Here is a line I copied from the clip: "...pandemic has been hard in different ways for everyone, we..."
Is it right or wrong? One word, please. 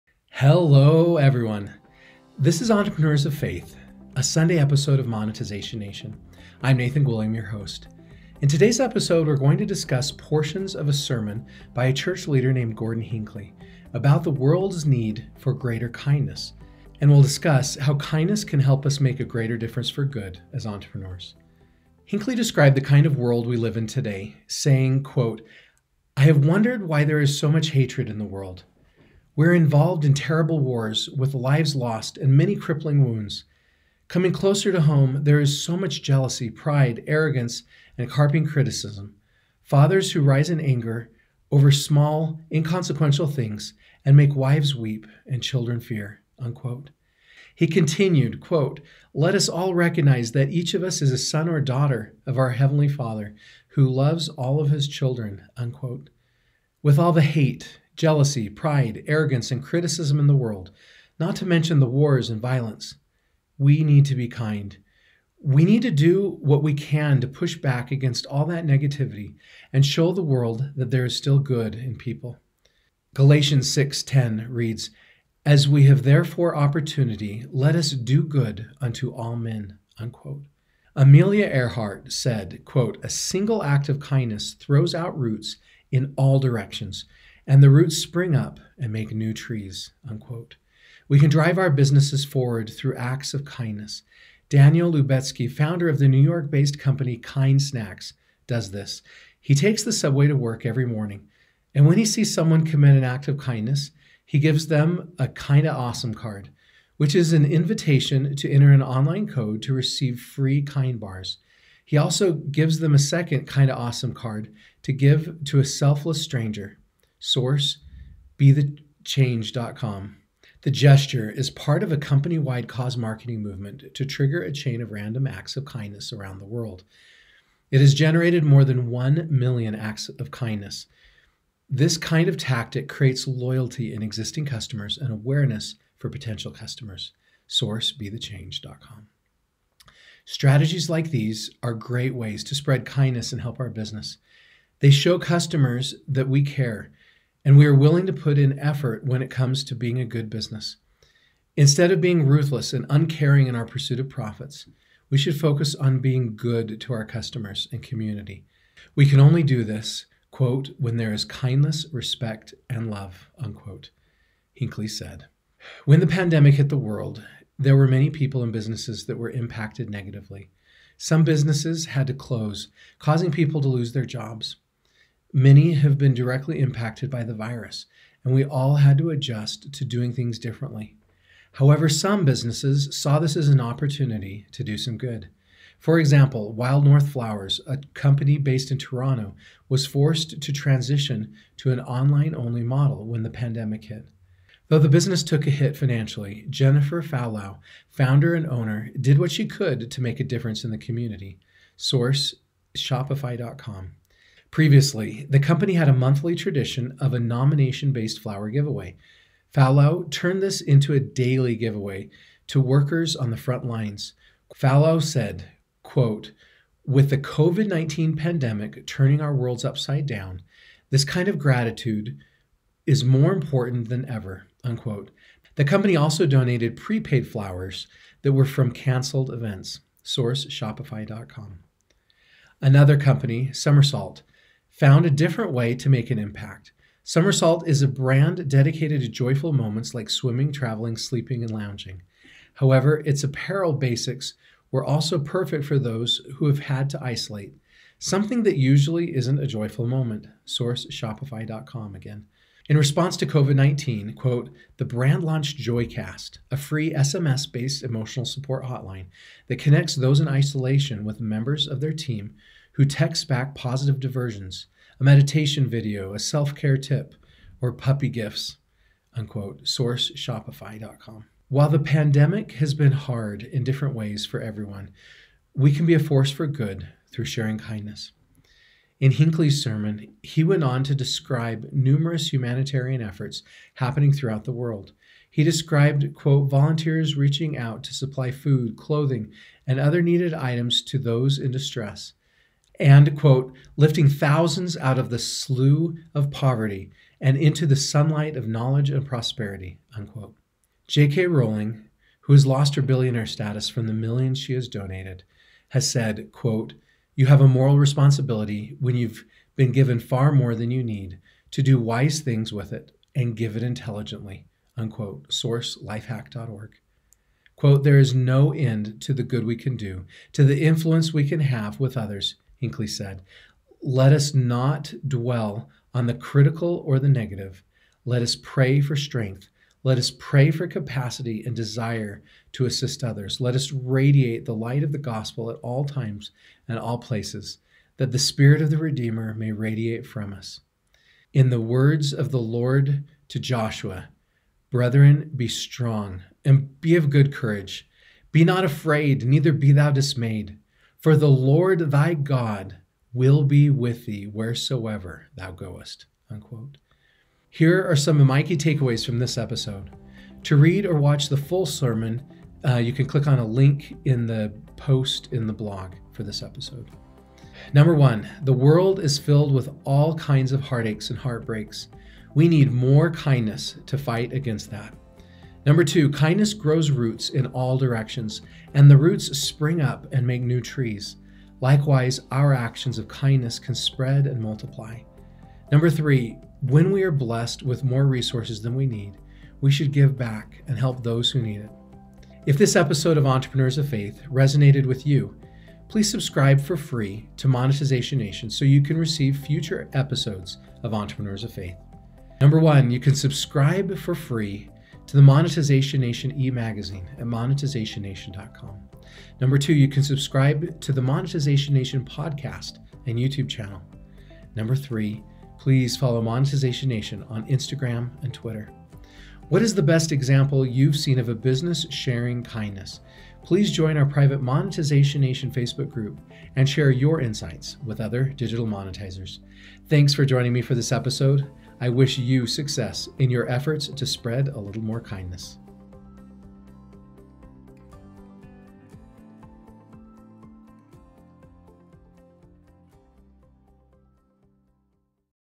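right.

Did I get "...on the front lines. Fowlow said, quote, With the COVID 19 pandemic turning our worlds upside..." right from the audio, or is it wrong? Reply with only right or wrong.
right.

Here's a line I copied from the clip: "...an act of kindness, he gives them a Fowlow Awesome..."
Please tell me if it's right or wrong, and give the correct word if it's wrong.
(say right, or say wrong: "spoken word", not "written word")
wrong: "Kinda", not "Fowlow".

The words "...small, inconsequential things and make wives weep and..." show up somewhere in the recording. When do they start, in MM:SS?
00:41.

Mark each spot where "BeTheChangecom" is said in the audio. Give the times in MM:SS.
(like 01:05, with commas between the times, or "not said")
01:58, 02:17.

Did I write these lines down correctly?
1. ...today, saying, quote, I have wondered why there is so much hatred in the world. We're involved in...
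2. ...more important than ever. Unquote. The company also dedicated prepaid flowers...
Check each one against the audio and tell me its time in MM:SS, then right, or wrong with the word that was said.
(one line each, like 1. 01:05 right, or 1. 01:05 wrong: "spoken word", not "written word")
1. 00:23 right
2. 03:43 wrong: "donated", not "dedicated".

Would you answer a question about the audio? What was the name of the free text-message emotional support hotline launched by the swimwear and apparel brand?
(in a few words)
Joycast.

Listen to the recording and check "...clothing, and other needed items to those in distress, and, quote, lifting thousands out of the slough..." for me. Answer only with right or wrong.
right.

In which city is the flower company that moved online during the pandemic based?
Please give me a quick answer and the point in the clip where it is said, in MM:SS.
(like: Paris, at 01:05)
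Toronto, at 03:08.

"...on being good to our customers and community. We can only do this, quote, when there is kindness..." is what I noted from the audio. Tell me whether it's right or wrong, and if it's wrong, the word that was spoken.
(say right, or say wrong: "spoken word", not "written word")
right.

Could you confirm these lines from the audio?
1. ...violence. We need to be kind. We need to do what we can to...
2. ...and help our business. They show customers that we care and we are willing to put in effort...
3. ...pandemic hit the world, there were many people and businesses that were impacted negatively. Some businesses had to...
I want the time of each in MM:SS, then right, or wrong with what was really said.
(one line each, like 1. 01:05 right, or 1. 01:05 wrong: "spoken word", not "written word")
1. 01:02 right
2. 02:23 right
3. 02:46 right.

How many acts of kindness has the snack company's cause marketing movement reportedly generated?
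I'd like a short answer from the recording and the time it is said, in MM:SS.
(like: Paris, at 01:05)
more than 1 million, at 02:08.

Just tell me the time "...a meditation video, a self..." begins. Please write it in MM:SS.
04:24.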